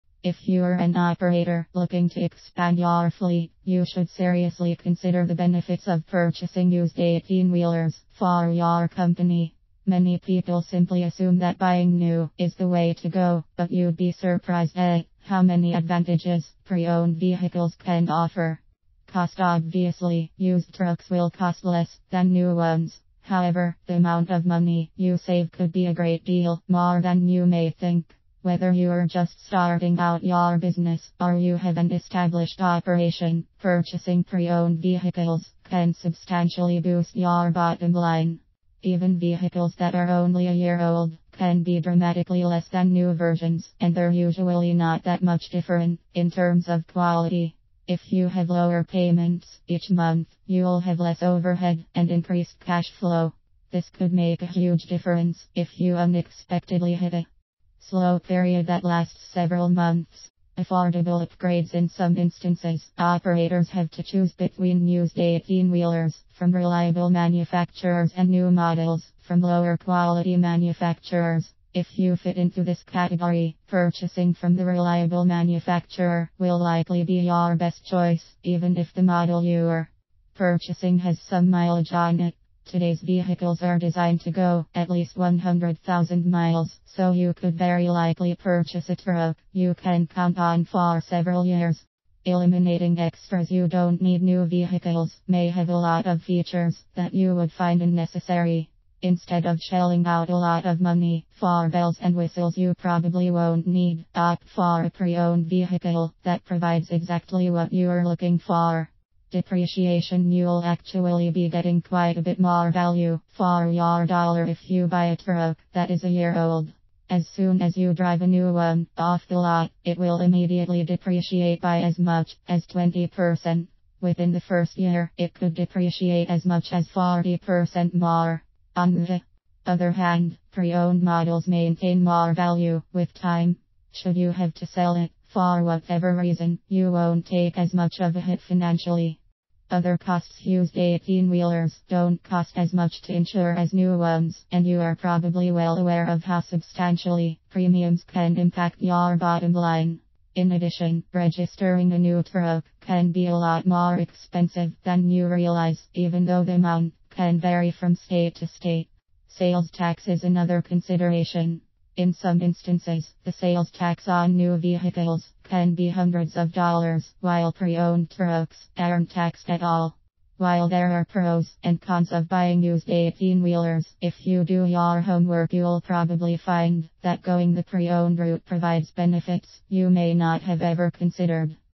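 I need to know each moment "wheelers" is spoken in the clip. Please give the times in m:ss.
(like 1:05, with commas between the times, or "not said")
0:07, 1:05, 2:21, 2:53.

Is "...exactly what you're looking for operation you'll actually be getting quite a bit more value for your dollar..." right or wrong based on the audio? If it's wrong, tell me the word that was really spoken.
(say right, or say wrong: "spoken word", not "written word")
wrong: "depreciation", not "operation".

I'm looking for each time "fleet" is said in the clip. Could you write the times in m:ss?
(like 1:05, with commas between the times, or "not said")
0:03.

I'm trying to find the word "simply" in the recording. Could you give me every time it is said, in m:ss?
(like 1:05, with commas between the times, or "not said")
0:10.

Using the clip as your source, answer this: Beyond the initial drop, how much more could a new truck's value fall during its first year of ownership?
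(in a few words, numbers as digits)
40%.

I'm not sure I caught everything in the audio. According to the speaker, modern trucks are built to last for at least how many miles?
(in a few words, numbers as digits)
100,000 miles.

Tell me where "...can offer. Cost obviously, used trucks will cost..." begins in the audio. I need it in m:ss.
0:17.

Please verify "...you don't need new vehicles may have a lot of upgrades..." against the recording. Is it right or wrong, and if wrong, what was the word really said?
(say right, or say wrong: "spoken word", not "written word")
wrong: "features", not "upgrades".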